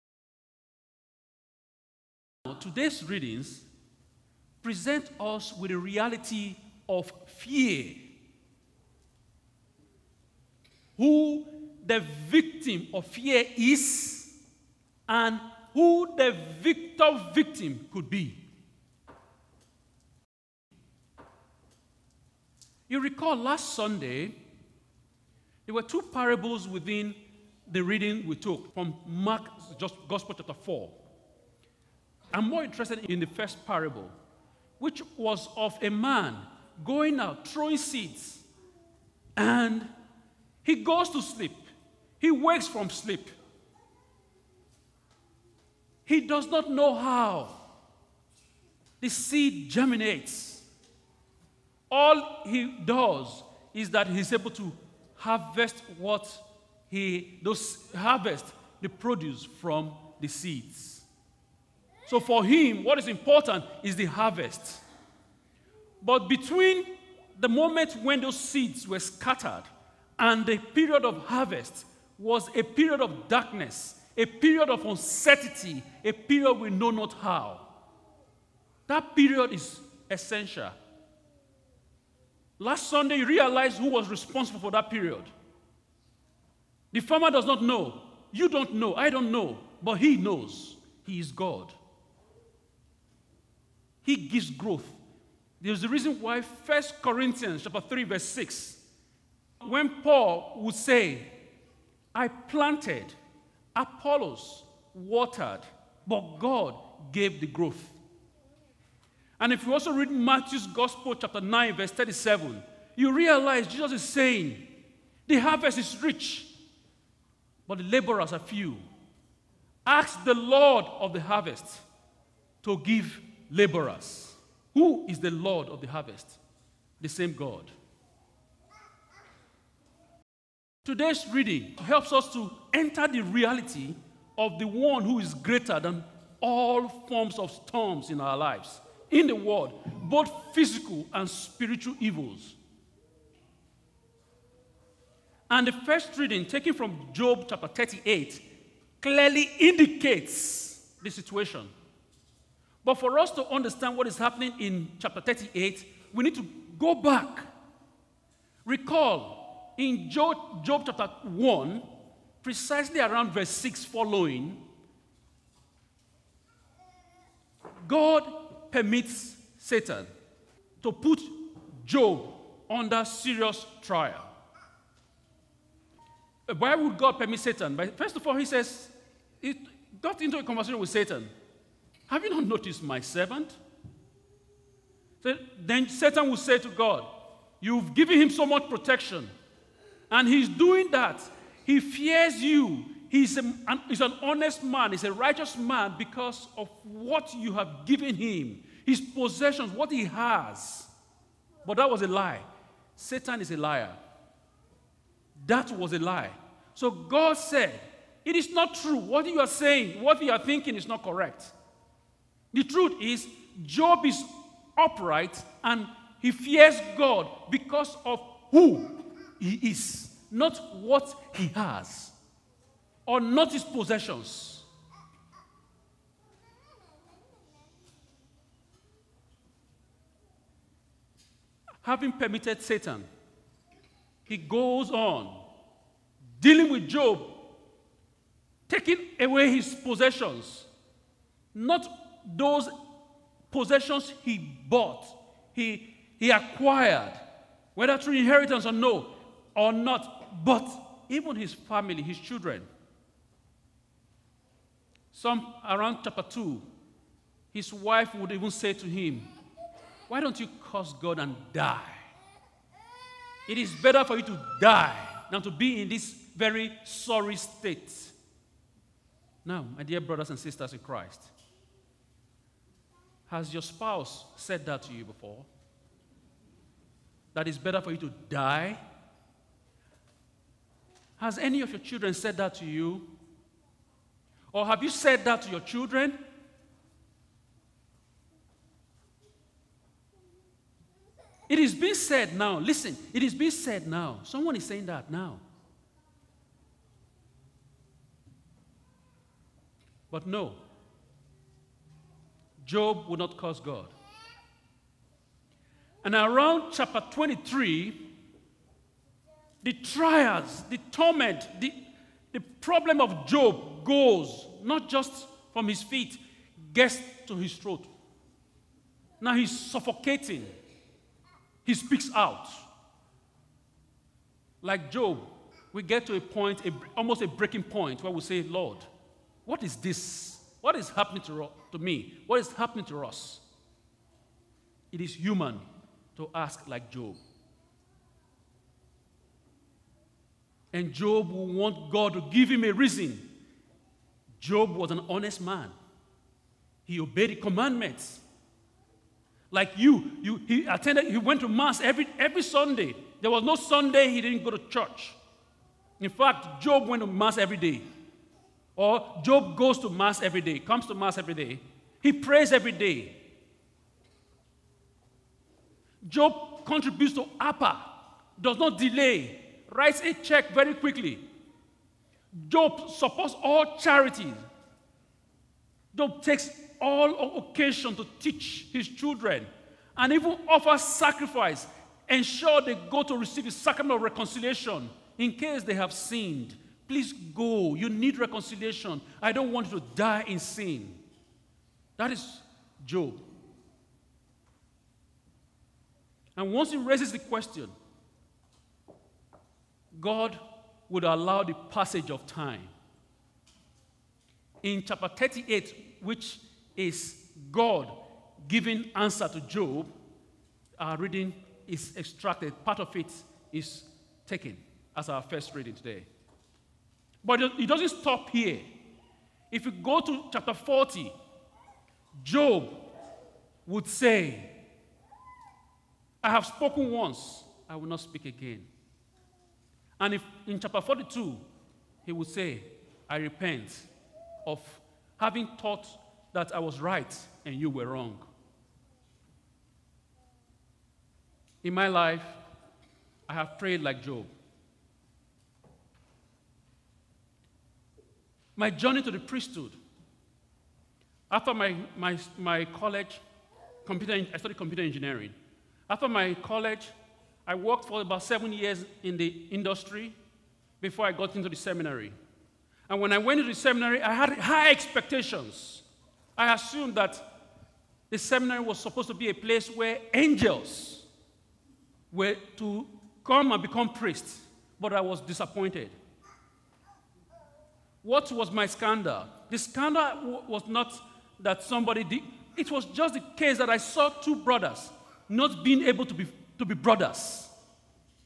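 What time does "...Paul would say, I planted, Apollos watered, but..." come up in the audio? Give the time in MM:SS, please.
01:40.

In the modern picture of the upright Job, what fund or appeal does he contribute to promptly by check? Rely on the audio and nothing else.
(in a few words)
APA.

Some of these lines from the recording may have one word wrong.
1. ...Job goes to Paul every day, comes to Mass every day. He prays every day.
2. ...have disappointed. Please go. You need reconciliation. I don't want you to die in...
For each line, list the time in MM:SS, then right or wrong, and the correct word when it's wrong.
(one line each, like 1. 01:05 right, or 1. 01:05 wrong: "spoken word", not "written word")
1. 05:59 wrong: "Mass", not "Paul"
2. 06:25 wrong: "sinned", not "disappointed".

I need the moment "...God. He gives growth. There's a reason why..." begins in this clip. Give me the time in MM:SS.
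01:31.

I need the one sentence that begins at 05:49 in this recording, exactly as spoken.
Like you, you he attended, he went to mass every, every Sunday.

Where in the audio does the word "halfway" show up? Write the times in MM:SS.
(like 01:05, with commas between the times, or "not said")
not said.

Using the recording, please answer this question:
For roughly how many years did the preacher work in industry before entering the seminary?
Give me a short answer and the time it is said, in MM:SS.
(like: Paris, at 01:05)
7, at 07:38.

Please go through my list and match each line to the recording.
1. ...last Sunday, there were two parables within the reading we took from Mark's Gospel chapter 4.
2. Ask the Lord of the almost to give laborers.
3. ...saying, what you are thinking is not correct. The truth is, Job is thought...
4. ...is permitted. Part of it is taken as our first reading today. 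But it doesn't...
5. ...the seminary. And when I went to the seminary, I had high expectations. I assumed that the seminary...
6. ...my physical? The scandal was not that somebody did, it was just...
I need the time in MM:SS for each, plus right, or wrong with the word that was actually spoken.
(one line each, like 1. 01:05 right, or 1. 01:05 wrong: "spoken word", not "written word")
1. 00:23 right
2. 01:59 wrong: "harvest", not "almost"
3. 03:29 wrong: "upright", not "thought"
4. 06:51 wrong: "extracted", not "permitted"
5. 07:41 right
6. 07:58 wrong: "scandal", not "physical".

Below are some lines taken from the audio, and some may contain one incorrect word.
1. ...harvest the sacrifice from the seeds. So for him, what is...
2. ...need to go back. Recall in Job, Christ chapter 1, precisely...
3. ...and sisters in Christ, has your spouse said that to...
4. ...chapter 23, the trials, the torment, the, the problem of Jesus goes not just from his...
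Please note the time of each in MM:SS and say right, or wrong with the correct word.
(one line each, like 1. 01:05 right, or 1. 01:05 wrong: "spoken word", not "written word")
1. 00:57 wrong: "produce", not "sacrifice"
2. 02:36 wrong: "Job", not "Christ"
3. 04:30 right
4. 05:06 wrong: "Job", not "Jesus".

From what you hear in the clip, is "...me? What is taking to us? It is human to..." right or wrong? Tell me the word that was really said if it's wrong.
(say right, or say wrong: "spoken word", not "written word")
wrong: "happening", not "taking".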